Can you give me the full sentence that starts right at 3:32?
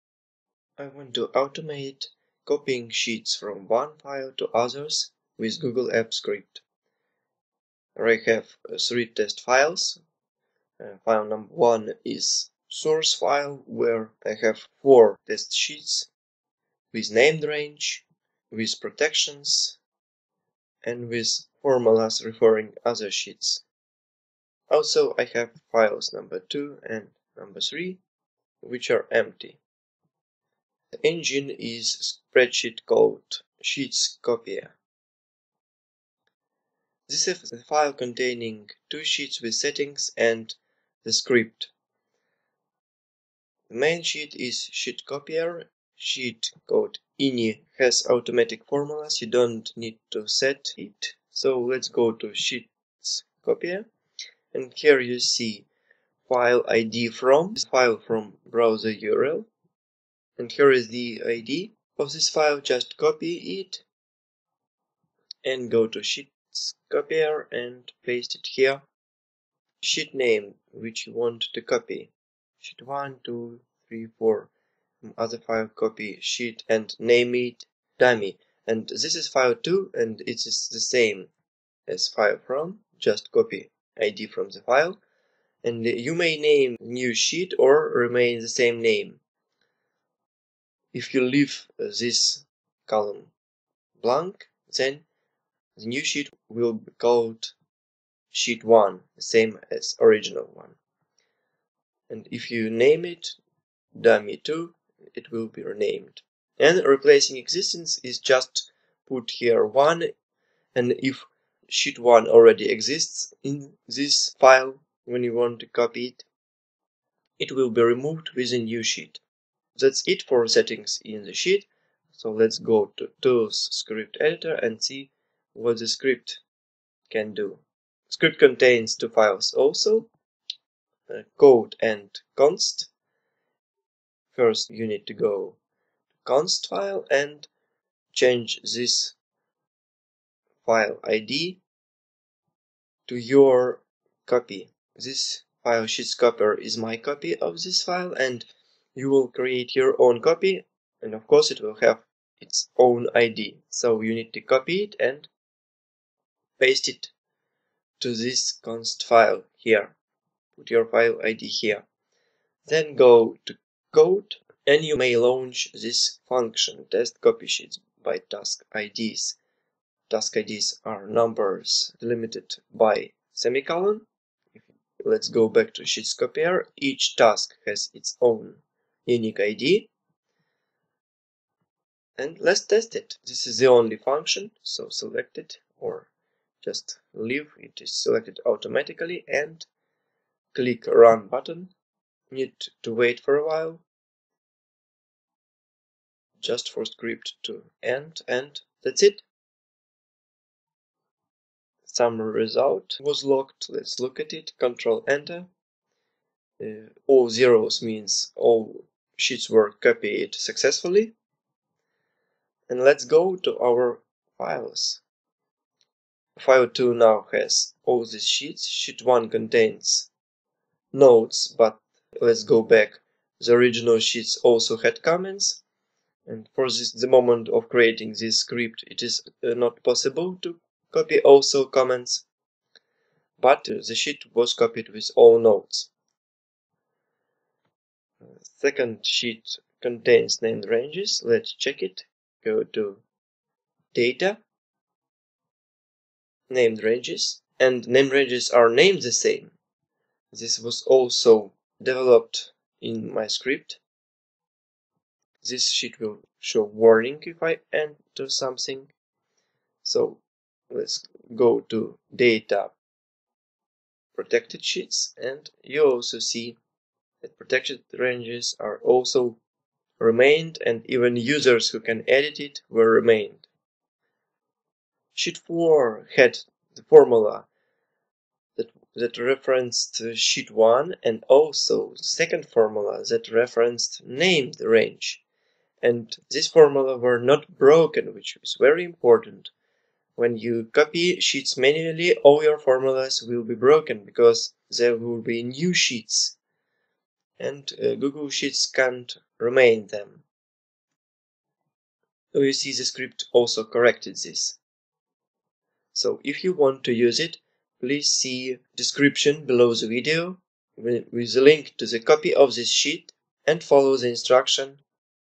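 And let's go to our files.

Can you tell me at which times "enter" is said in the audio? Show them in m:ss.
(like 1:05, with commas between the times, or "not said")
3:25, 4:17.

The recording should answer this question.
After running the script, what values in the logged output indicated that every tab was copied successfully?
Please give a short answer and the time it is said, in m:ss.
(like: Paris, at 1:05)
All zeros, at 3:27.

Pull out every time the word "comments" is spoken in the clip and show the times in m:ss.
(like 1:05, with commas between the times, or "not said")
3:45, 3:51.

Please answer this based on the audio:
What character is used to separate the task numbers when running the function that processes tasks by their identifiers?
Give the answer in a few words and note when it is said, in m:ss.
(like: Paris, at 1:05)
Semicolon, at 2:53.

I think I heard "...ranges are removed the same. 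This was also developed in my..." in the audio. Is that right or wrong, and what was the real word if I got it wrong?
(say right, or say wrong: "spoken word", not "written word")
wrong: "named", not "removed".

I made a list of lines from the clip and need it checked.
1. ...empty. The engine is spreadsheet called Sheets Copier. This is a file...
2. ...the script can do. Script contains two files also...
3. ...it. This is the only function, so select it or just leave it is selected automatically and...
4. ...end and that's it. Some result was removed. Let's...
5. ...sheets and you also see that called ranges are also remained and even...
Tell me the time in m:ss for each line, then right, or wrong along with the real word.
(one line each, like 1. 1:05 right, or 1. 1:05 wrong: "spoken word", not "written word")
1. 0:29 right
2. 2:05 right
3. 3:02 right
4. 3:17 wrong: "locked", not "removed"
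5. 4:24 wrong: "protected", not "called".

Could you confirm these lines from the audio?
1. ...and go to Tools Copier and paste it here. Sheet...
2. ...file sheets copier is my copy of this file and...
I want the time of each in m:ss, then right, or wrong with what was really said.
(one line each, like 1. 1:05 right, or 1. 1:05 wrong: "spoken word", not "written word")
1. 1:05 wrong: "Sheets", not "Tools"
2. 2:25 right.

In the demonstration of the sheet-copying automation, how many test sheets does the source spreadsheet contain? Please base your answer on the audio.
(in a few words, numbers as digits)
4.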